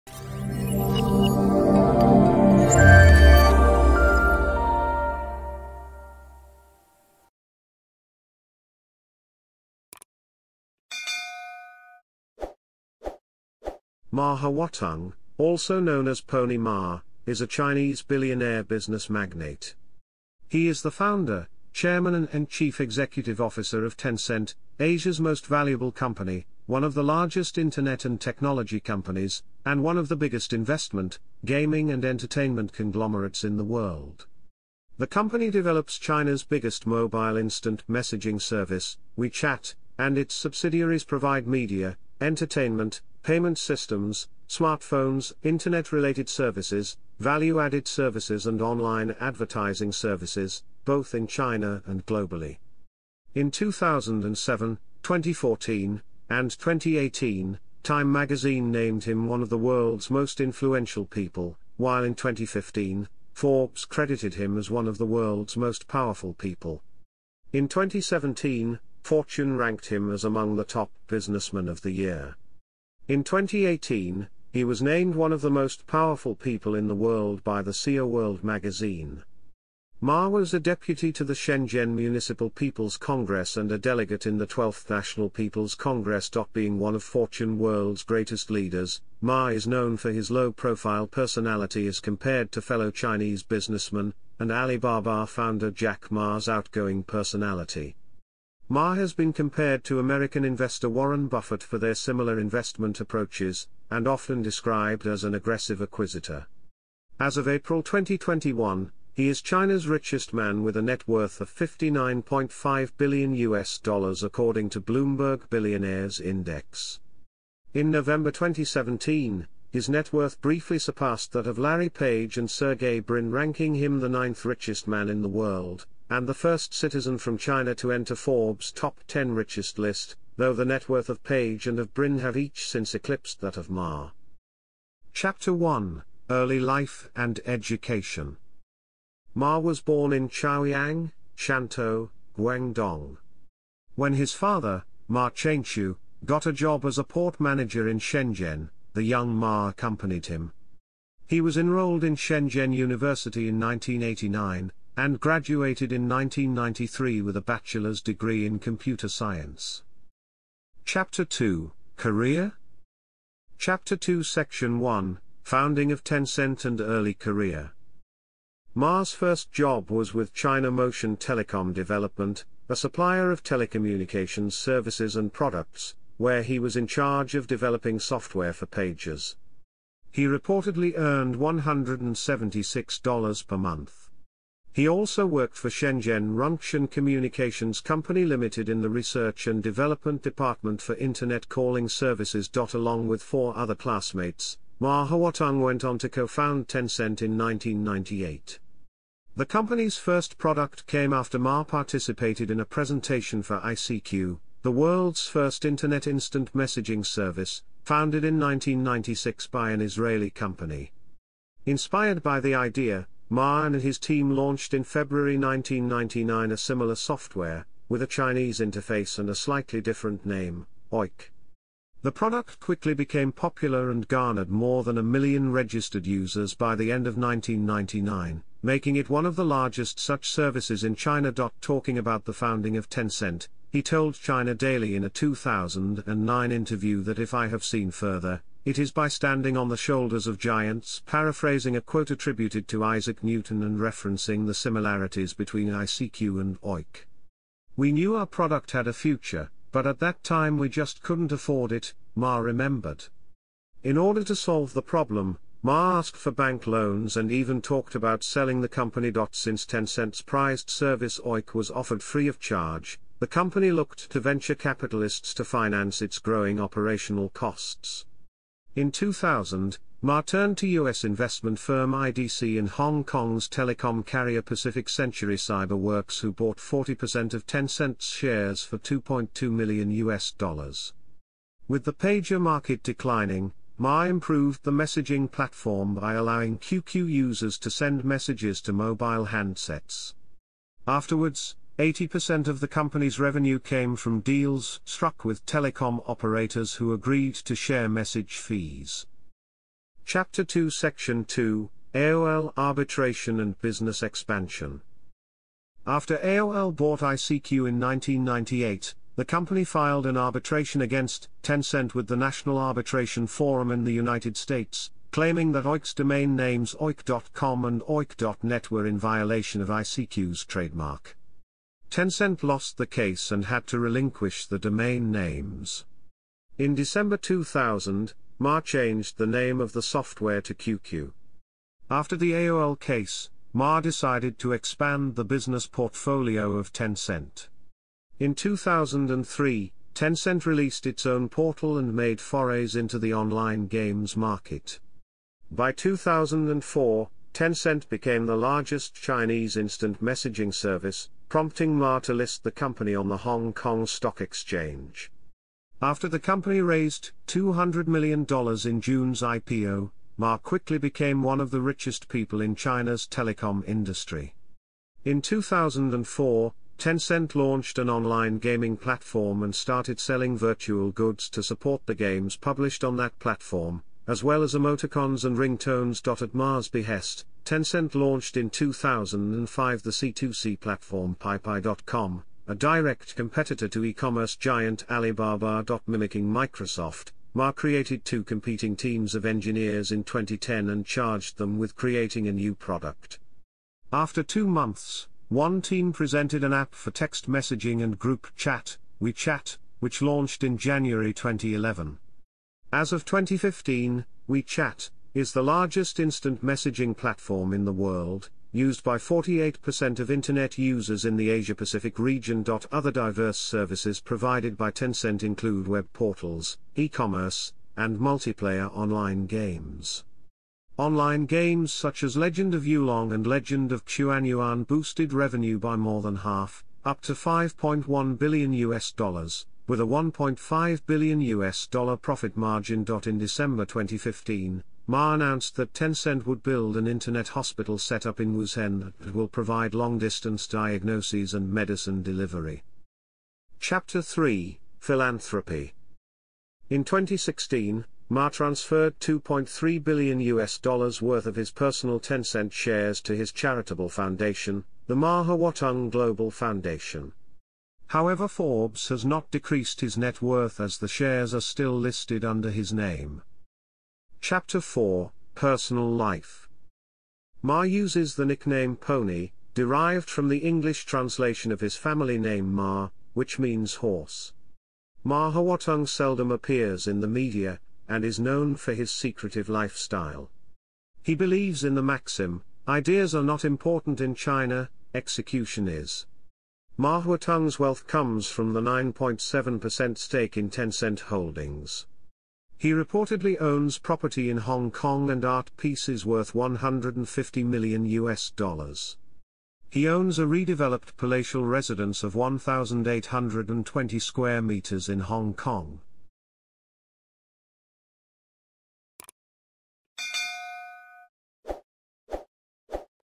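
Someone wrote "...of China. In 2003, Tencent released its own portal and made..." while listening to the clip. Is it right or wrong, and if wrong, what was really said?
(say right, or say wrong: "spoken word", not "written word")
wrong: "Tencent", not "China".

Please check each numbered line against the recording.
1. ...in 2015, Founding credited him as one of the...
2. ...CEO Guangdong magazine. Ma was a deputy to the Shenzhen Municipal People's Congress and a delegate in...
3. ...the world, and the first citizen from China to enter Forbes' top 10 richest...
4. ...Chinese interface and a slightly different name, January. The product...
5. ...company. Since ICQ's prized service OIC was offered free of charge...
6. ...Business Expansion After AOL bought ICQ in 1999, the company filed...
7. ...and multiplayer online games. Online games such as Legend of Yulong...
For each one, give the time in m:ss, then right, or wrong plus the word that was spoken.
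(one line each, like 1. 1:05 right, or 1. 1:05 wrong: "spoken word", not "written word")
1. 1:02 wrong: "Forbes", not "Founding"
2. 1:17 wrong: "World", not "Guangdong"
3. 2:05 right
4. 3:38 wrong: "Oic", not "January"
5. 4:18 wrong: "Tencent", not "ICQ"
6. 5:03 wrong: "1998", not "1999"
7. 6:57 right.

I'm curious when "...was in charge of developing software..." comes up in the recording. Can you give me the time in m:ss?
2:56.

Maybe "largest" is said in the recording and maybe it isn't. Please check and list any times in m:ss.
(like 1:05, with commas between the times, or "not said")
0:27, 3:49, 5:48, 6:45.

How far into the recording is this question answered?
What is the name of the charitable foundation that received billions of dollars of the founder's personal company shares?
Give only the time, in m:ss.
7:34.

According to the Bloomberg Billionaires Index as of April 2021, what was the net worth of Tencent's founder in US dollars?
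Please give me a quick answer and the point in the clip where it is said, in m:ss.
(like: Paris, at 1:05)
59.5 billion US dollars, at 1:51.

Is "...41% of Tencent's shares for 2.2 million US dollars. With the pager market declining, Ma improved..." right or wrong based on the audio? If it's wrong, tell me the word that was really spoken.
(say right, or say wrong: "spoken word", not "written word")
wrong: "40", not "41".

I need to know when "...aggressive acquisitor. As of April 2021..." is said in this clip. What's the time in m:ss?
1:45.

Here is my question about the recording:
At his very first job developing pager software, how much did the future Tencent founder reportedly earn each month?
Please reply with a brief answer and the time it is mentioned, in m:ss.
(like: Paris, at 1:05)
$176, at 3:01.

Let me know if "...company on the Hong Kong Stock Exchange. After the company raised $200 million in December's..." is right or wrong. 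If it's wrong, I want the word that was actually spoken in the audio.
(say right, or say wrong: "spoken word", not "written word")
wrong: "June", not "December".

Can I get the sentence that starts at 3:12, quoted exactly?
Along with four other classmates, Ma Huateng went on to co-found Tencent in 1998.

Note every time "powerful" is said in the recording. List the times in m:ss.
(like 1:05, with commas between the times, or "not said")
1:05, 1:15.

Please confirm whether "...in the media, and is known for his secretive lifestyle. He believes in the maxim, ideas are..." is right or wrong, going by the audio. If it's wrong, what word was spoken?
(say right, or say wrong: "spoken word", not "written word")
right.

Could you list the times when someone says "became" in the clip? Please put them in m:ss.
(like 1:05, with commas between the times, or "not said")
3:42, 5:47, 6:00.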